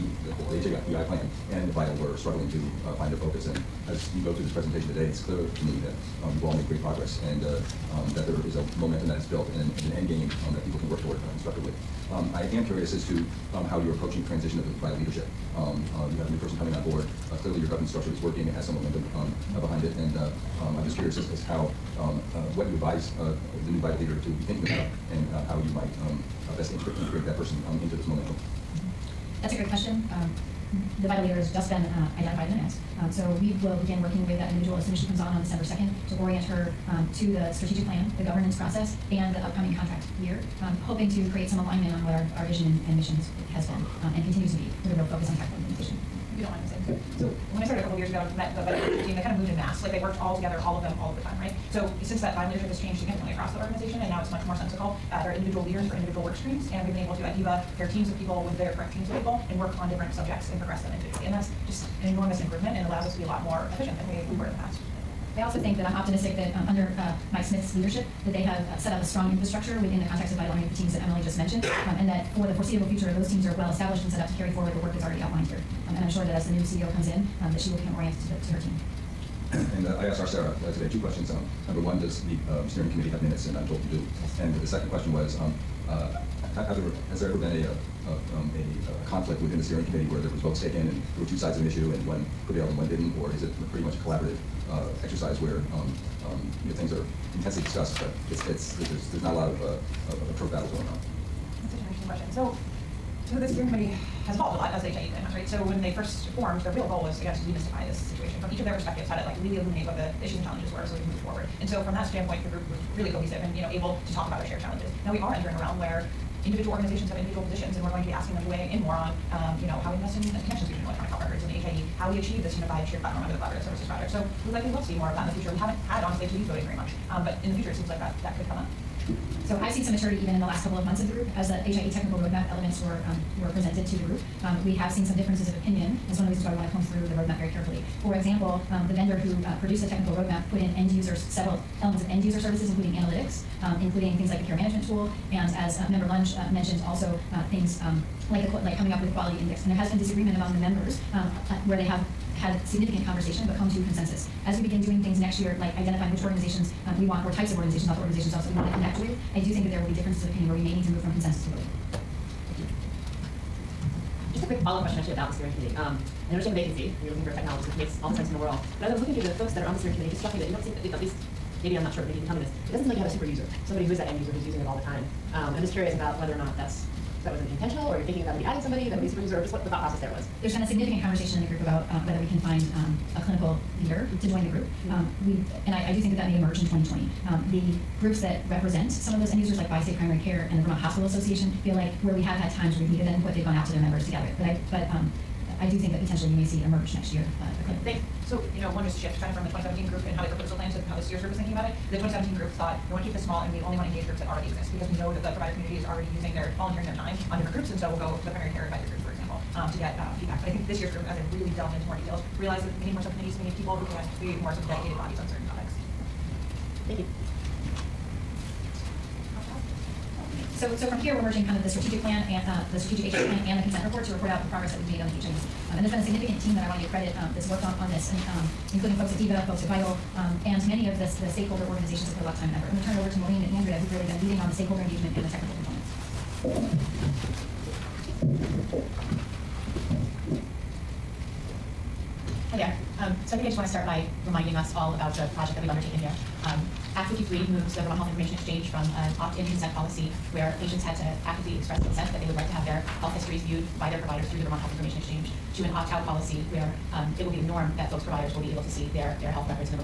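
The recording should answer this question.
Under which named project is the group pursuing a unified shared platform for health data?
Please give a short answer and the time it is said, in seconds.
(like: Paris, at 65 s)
Collaborative Services Project, at 123 s.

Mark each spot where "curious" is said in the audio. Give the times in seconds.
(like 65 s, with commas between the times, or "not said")
12 s, 20 s, 175 s.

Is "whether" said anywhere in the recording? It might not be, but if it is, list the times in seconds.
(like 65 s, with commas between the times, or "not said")
176 s, 182 s.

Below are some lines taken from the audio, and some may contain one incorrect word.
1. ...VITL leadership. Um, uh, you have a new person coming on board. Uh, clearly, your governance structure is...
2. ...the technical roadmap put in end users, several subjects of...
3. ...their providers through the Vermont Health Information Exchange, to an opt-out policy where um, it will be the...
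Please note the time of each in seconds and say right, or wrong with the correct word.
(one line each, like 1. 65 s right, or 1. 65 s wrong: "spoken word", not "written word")
1. 14 s right
2. 139 s wrong: "elements", not "subjects"
3. 253 s right.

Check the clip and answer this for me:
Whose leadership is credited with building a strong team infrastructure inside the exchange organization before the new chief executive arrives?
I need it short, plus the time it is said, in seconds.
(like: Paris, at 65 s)
Mike Smith, at 67 s.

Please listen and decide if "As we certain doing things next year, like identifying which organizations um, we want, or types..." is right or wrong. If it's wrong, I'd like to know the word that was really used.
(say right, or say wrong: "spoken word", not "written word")
wrong: "begin", not "certain".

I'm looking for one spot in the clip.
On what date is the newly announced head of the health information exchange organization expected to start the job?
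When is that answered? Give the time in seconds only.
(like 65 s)
35 s.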